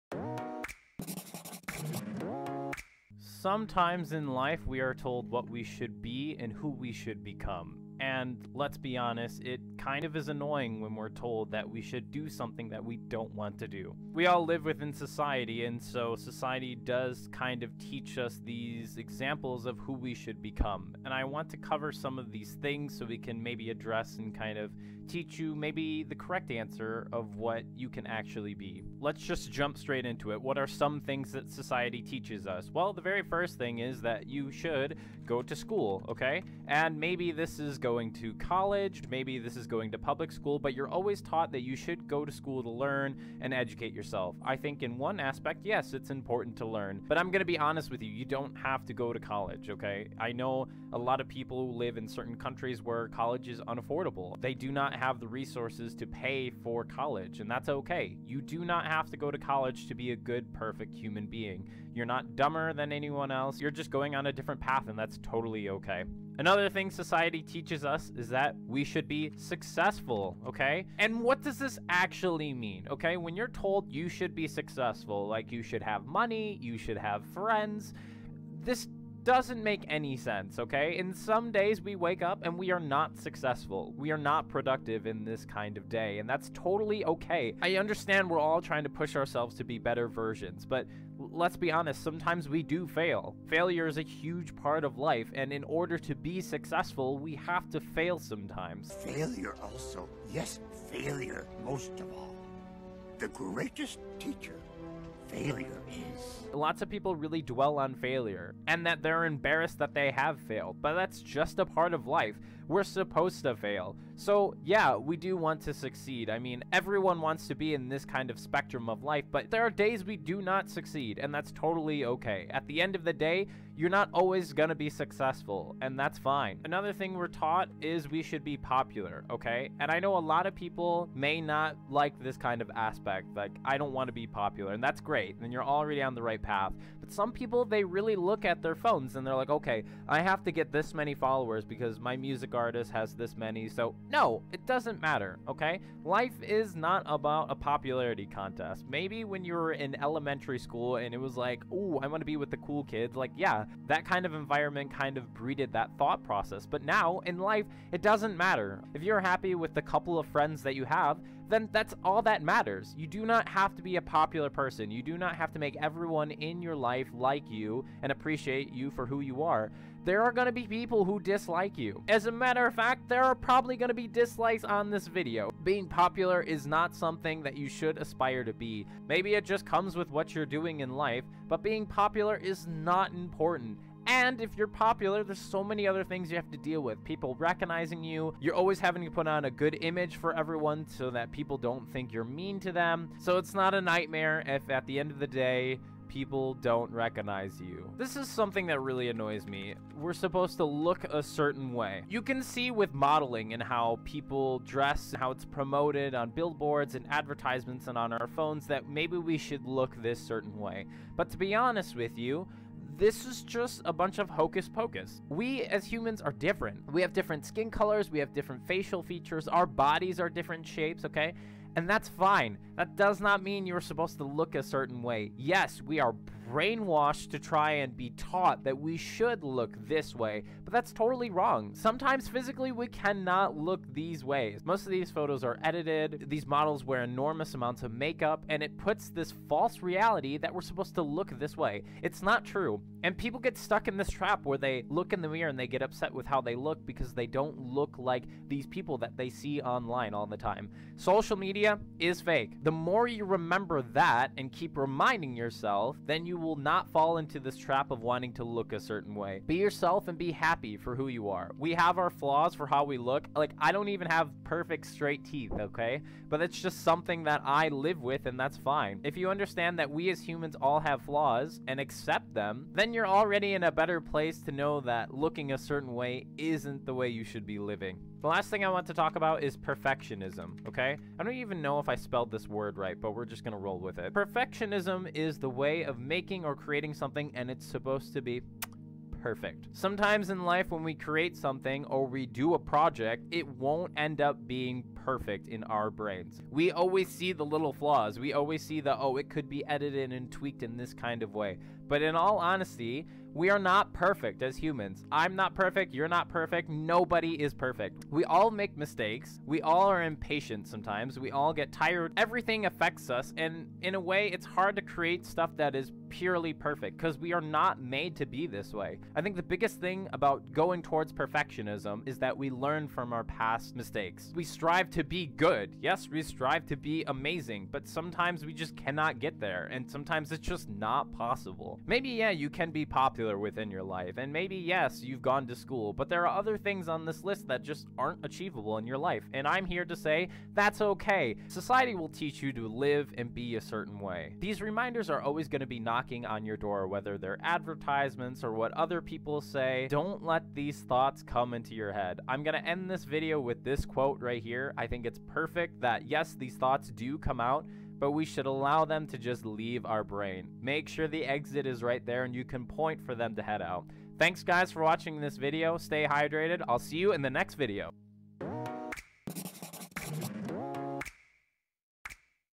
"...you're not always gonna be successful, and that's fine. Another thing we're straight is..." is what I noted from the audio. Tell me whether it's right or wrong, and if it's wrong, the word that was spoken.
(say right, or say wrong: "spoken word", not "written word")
wrong: "taught", not "straight".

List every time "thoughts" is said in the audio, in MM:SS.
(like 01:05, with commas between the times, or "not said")
02:35, 05:50, 05:56.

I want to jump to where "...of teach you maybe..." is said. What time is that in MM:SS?
00:24.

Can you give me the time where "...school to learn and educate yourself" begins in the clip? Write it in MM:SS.
00:42.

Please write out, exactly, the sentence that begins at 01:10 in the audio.
And what does this actually mean, okay?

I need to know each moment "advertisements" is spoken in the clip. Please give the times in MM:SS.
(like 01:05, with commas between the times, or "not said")
03:27, 05:47.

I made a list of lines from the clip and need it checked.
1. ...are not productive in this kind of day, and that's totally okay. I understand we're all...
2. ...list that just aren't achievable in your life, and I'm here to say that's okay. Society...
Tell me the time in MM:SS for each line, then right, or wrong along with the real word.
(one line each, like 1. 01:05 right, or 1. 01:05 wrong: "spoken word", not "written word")
1. 01:24 right
2. 05:37 right.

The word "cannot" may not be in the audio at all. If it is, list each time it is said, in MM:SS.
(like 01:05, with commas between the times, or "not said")
03:52, 05:28.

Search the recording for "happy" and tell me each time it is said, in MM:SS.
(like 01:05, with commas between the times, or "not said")
02:39, 04:20.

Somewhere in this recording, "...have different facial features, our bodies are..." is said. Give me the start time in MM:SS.
03:38.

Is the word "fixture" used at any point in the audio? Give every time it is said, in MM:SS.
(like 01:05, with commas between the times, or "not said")
not said.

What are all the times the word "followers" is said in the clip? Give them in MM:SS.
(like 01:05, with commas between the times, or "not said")
02:21.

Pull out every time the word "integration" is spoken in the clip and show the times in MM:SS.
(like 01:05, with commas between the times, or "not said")
not said.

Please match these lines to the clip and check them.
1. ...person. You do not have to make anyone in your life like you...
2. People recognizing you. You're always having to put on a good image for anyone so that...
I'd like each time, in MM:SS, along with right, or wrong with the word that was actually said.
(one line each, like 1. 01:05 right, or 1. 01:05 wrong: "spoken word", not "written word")
1. 02:44 wrong: "everyone", not "anyone"
2. 03:07 wrong: "everyone", not "anyone".